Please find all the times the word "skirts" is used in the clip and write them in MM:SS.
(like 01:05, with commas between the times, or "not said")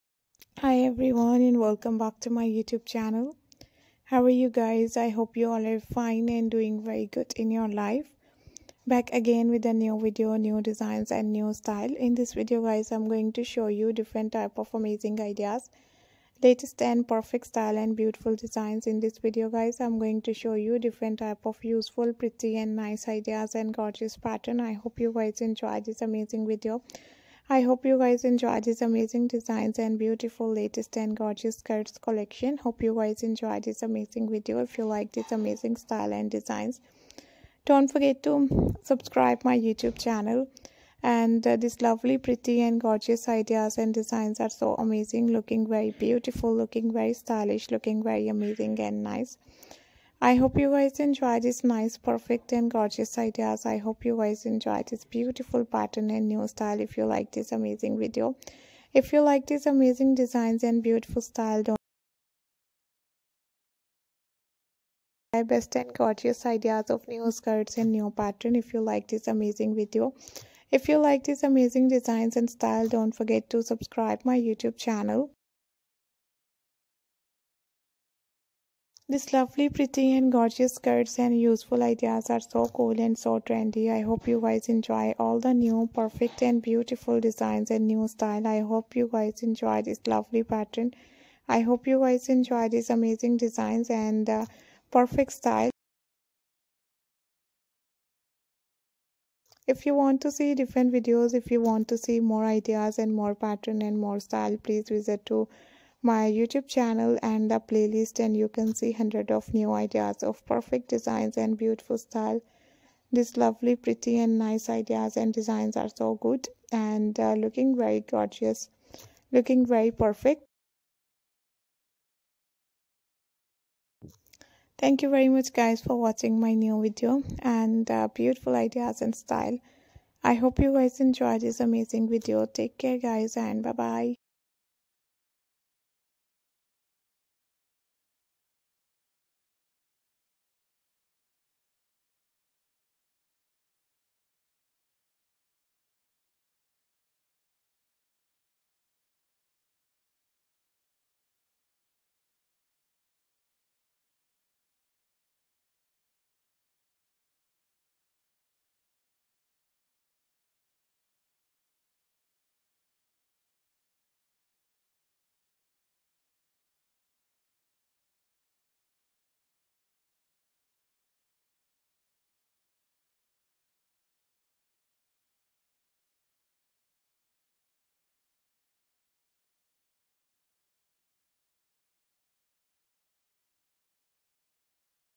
00:31, 01:07, 01:20.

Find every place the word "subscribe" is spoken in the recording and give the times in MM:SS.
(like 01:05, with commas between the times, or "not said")
00:38, 01:13.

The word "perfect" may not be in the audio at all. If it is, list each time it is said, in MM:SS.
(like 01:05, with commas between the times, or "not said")
00:17, 00:51, 01:25, 01:34, 01:50, 01:59.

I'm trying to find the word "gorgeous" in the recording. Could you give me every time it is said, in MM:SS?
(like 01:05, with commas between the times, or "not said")
00:23, 00:31, 00:42, 00:52, 01:05, 01:20, 01:58.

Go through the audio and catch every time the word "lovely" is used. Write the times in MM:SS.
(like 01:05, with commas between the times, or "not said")
00:41, 01:19, 01:30, 01:53.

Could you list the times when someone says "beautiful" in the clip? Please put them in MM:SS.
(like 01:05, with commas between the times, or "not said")
00:17, 00:29, 00:45, 00:55, 01:00, 01:26, 01:51, 02:08.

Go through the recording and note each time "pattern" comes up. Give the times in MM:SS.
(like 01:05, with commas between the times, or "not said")
00:24, 00:55, 01:08, 01:30, 01:43.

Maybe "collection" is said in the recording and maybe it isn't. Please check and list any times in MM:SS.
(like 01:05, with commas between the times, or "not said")
00:31.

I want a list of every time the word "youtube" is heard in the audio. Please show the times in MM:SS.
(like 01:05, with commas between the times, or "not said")
00:02, 00:39, 01:14, 01:46.